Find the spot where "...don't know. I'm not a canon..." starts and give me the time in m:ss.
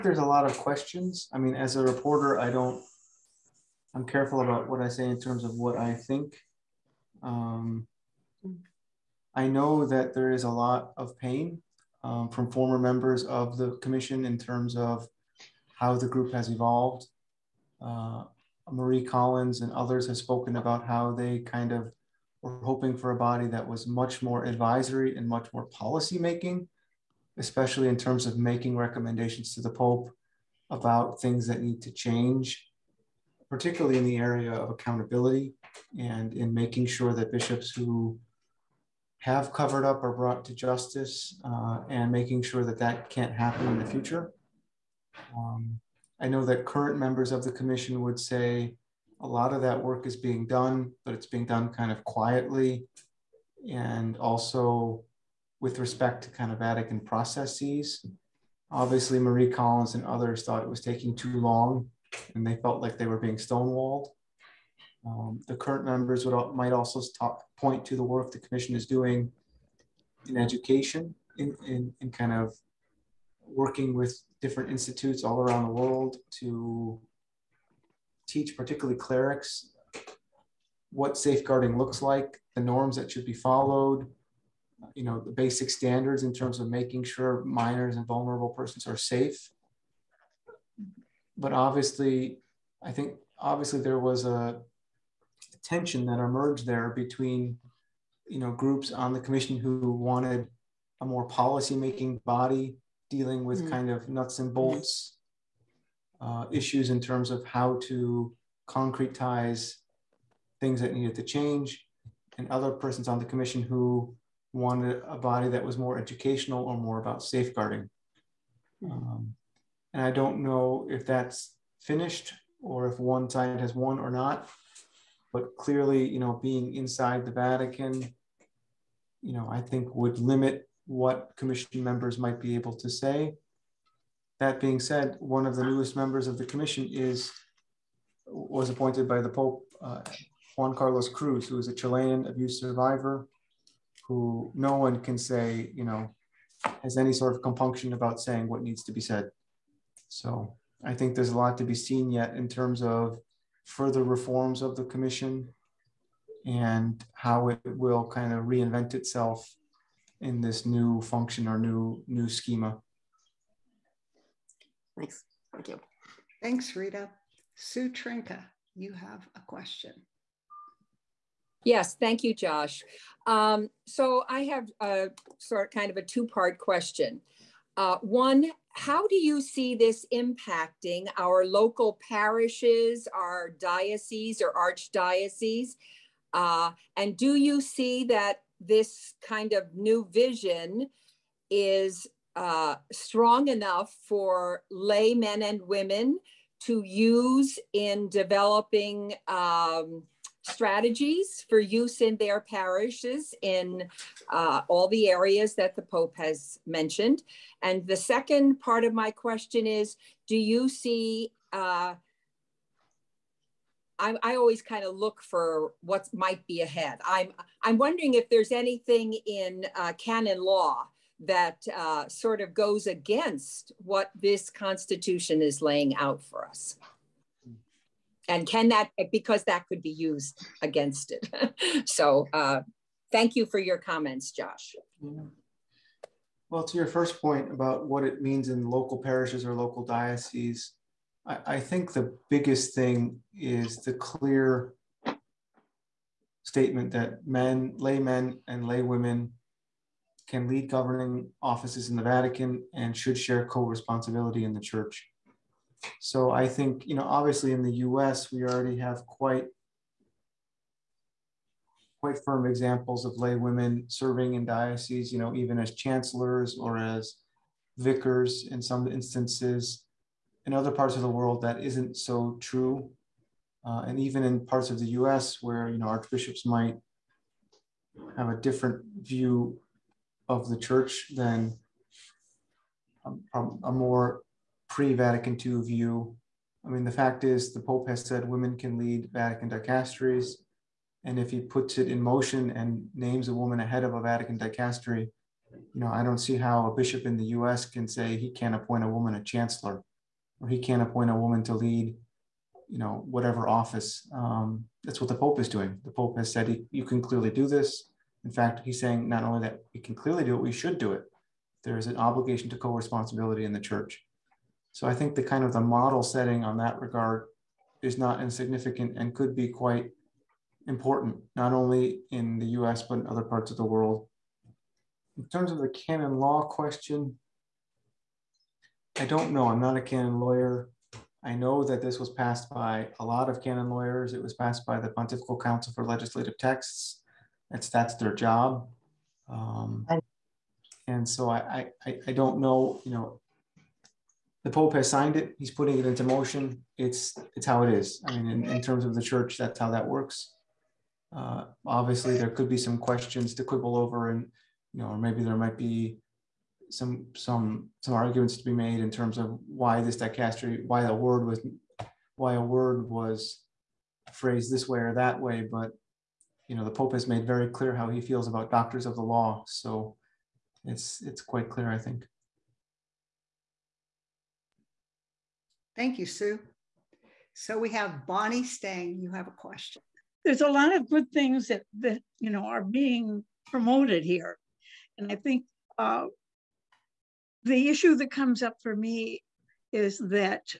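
5:29.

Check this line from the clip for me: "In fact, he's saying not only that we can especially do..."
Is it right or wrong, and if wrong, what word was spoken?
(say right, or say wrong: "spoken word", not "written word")
wrong: "clearly", not "especially".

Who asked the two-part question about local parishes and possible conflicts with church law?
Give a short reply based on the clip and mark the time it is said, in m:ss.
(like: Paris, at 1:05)
Sue Trinka, at 2:47.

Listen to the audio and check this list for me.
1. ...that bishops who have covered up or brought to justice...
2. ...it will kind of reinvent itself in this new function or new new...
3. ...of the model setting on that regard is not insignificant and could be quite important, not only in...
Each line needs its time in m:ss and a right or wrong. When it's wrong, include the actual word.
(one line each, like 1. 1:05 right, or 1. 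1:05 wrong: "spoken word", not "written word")
1. 0:37 right
2. 2:37 right
3. 5:15 right.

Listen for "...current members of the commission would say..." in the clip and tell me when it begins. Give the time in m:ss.
0:46.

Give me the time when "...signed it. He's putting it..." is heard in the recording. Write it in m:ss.
5:44.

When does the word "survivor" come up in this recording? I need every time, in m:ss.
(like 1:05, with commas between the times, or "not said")
2:22.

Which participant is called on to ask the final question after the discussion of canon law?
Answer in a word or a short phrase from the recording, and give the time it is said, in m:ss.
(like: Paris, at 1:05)
Bonnie Stang, at 6:18.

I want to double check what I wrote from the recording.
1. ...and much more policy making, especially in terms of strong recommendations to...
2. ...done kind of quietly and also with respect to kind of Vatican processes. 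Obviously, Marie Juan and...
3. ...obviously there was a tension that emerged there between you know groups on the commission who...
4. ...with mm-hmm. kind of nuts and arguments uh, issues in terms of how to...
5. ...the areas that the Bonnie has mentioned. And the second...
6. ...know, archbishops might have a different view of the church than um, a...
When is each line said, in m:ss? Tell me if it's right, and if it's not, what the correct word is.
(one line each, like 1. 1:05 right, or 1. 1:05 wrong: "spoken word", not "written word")
1. 0:25 wrong: "making", not "strong"
2. 0:51 wrong: "Collins", not "Juan"
3. 1:33 right
4. 1:43 wrong: "bolts", not "arguments"
5. 3:24 wrong: "Pope", not "Bonnie"
6. 4:35 right.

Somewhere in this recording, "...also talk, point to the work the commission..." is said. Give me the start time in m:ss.
1:06.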